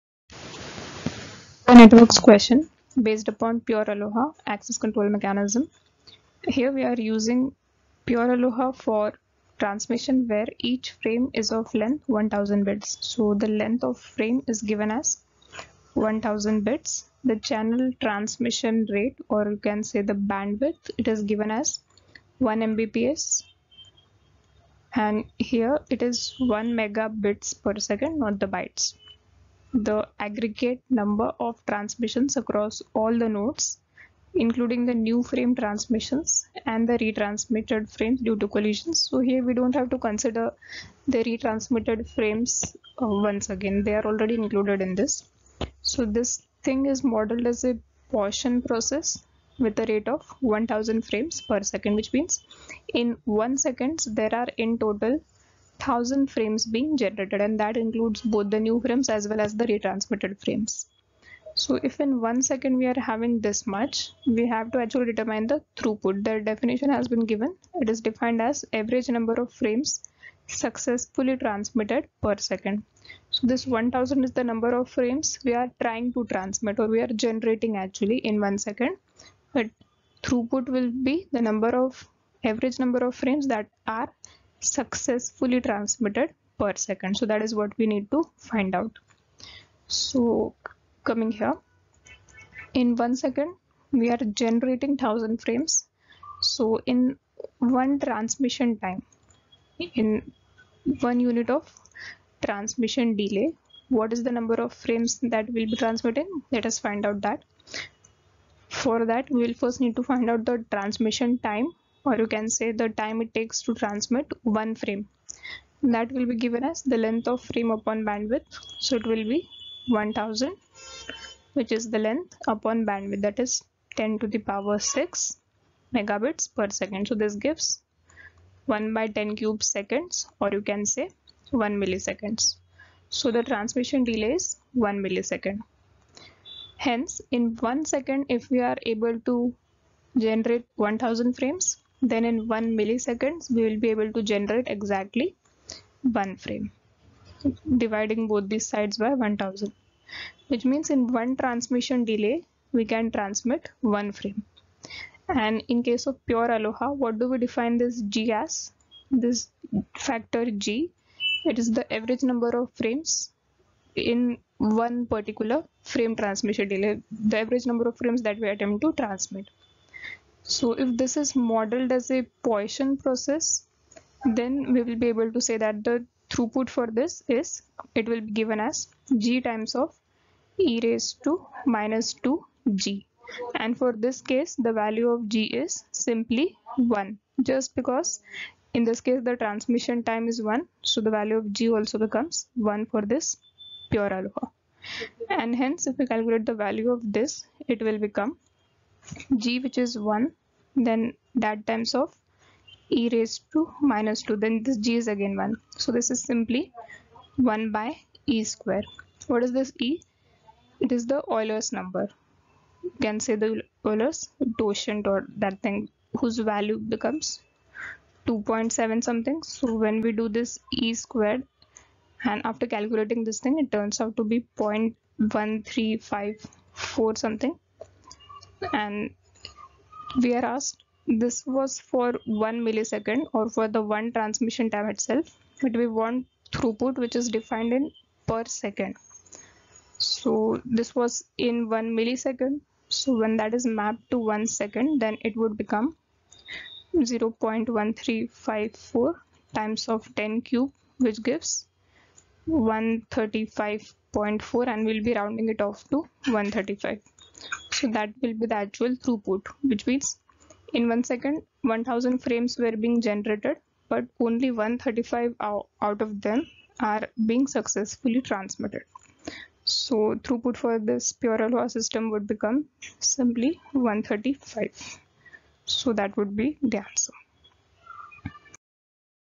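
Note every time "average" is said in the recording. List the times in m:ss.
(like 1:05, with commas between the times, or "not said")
1:08, 1:22, 2:41, 2:47.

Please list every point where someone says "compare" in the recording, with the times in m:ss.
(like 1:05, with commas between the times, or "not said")
not said.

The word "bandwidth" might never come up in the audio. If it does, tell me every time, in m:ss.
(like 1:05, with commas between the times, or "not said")
0:20, 1:58, 2:02.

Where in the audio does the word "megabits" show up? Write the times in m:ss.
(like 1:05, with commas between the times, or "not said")
0:26, 2:05.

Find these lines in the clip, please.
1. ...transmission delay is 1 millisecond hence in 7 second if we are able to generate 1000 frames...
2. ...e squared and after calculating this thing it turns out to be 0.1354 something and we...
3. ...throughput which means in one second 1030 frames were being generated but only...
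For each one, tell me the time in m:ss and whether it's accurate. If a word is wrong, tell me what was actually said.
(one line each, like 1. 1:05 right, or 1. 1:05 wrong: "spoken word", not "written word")
1. 2:13 wrong: "1", not "7"
2. 3:40 right
3. 4:19 wrong: "1000", not "1030".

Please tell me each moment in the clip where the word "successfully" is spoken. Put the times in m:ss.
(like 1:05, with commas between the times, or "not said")
1:10, 1:24, 4:27.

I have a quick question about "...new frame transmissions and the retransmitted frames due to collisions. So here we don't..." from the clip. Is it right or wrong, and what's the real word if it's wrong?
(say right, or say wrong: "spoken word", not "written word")
right.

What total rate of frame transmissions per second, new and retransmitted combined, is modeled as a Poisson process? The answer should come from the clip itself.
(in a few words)
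1000 frames per second.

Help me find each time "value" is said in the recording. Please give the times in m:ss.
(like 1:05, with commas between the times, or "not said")
3:04, 3:11, 3:16, 3:36.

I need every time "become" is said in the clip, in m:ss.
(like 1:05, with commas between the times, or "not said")
3:11, 3:17, 3:36, 4:05, 4:32.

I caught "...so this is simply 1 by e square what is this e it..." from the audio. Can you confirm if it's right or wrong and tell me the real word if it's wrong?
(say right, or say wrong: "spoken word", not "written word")
right.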